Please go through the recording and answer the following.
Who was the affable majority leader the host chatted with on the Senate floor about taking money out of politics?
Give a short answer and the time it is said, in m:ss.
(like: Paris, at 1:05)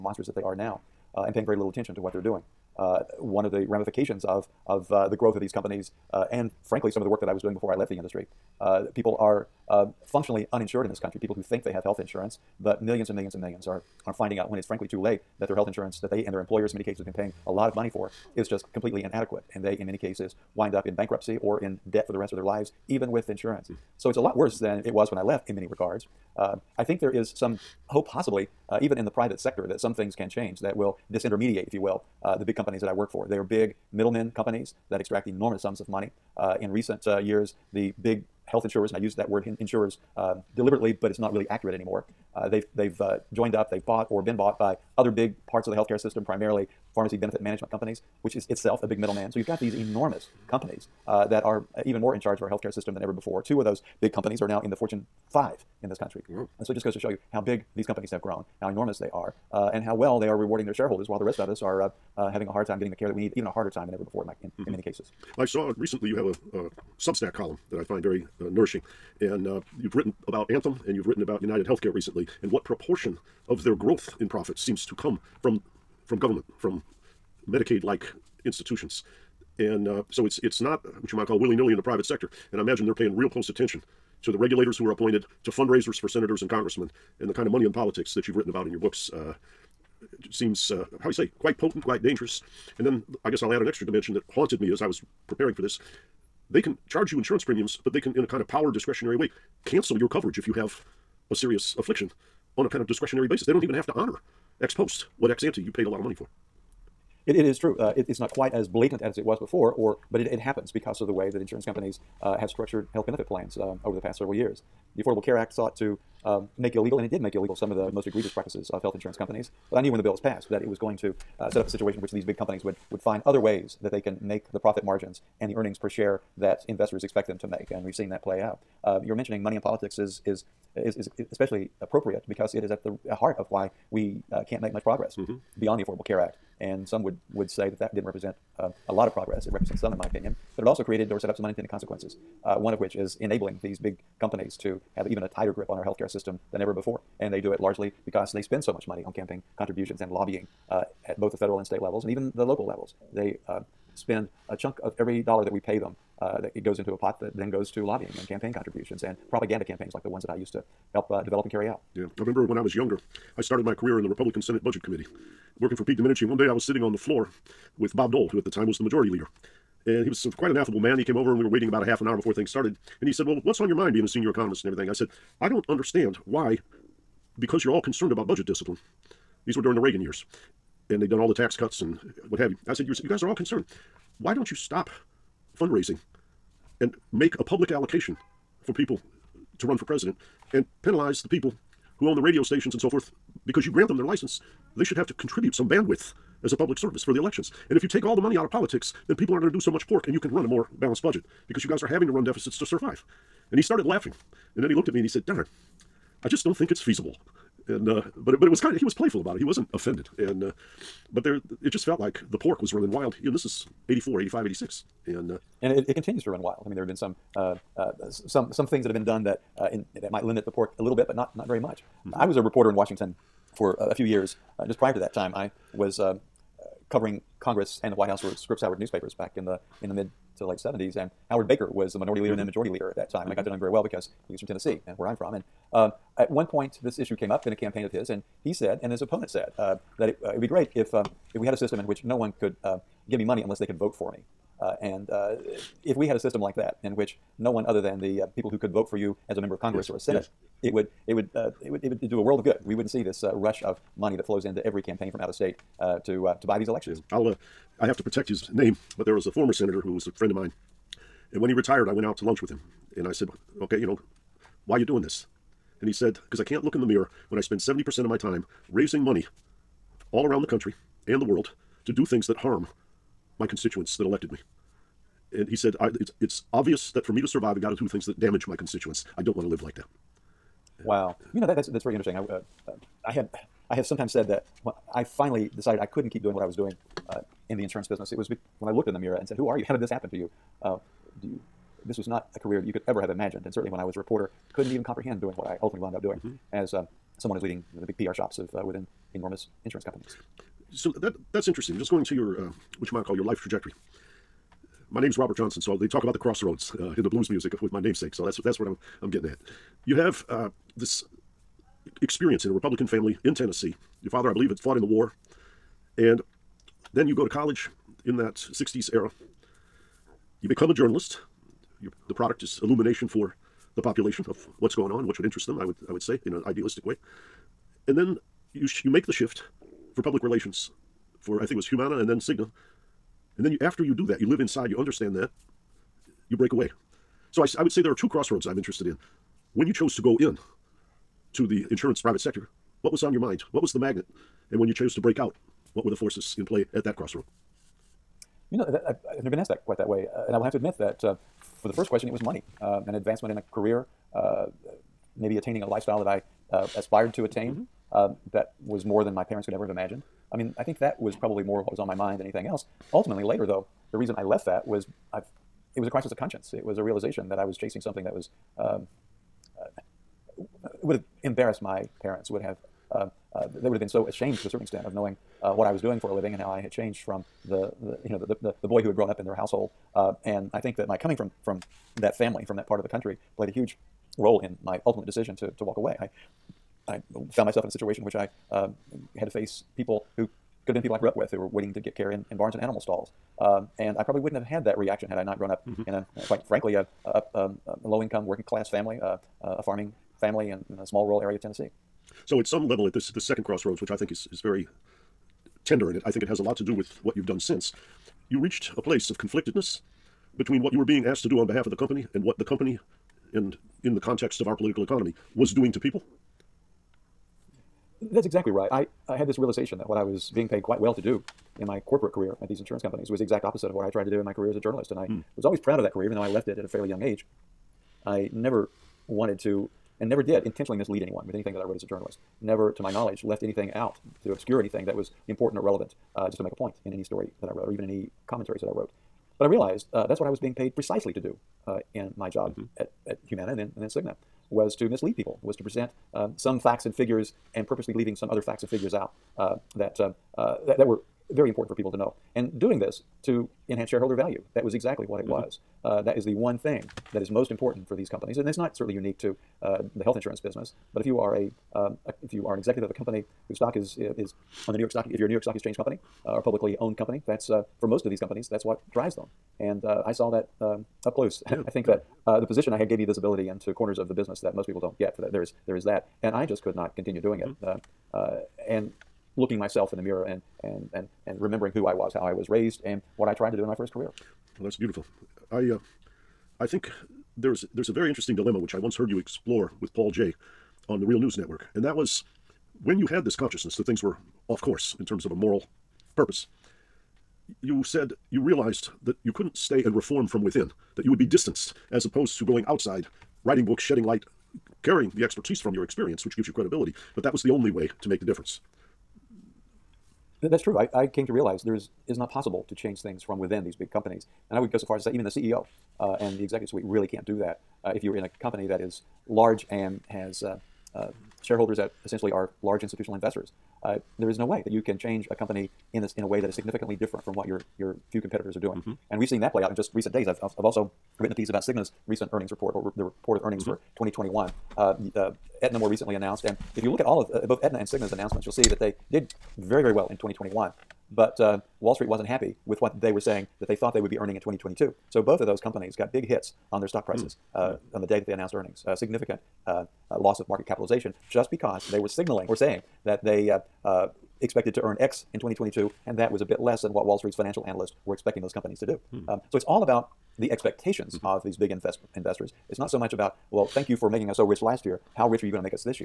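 Bob Dole, at 2:47.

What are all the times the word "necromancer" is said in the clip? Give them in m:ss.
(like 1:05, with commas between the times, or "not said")
not said.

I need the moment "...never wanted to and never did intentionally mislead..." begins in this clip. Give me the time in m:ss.
7:08.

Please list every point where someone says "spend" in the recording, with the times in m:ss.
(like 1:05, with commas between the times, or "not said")
2:28, 2:33, 4:27.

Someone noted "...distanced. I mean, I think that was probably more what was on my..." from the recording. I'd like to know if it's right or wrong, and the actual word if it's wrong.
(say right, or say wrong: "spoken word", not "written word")
wrong: "imagined", not "distanced".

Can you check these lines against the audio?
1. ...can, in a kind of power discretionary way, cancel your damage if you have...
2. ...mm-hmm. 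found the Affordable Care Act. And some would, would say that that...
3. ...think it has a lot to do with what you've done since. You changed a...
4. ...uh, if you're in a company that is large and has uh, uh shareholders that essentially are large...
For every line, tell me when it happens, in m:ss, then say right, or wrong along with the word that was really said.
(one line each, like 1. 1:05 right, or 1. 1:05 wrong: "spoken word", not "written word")
1. 1:38 wrong: "coverage", not "damage"
2. 2:15 wrong: "beyond", not "found"
3. 6:46 wrong: "reached", not "changed"
4. 8:37 right.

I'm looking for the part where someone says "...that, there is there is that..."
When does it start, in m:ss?
7:55.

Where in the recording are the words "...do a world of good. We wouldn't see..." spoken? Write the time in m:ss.
4:12.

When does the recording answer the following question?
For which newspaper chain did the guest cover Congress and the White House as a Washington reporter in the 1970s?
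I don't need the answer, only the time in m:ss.
3:48.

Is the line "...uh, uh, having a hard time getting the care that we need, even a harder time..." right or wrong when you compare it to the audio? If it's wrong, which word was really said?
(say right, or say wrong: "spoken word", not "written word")
right.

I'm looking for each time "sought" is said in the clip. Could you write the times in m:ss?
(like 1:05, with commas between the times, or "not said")
1:55.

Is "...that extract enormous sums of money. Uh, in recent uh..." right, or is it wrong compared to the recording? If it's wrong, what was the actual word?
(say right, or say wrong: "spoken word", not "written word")
right.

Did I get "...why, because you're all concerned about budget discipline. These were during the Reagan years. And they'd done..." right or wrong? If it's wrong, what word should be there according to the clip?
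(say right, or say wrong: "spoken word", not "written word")
right.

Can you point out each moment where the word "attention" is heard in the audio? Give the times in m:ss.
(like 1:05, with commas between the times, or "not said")
0:01, 1:23.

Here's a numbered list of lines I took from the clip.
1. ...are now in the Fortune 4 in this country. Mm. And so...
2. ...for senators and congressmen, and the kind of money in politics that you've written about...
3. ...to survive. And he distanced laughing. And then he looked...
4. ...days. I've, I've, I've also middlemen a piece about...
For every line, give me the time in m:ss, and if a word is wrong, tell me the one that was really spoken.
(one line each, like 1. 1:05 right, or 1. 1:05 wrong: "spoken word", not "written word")
1. 0:54 wrong: "5", not "4"
2. 1:25 right
3. 3:22 wrong: "started", not "distanced"
4. 8:50 wrong: "written", not "middlemen".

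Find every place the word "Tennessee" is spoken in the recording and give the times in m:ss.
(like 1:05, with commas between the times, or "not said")
3:54, 5:13, 6:41.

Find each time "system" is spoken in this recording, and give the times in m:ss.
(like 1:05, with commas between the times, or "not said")
0:45, 0:52, 2:26, 4:01, 4:06.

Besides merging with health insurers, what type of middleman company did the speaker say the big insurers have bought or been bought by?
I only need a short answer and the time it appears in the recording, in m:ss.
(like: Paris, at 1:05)
pharmacy benefit management companies, at 0:46.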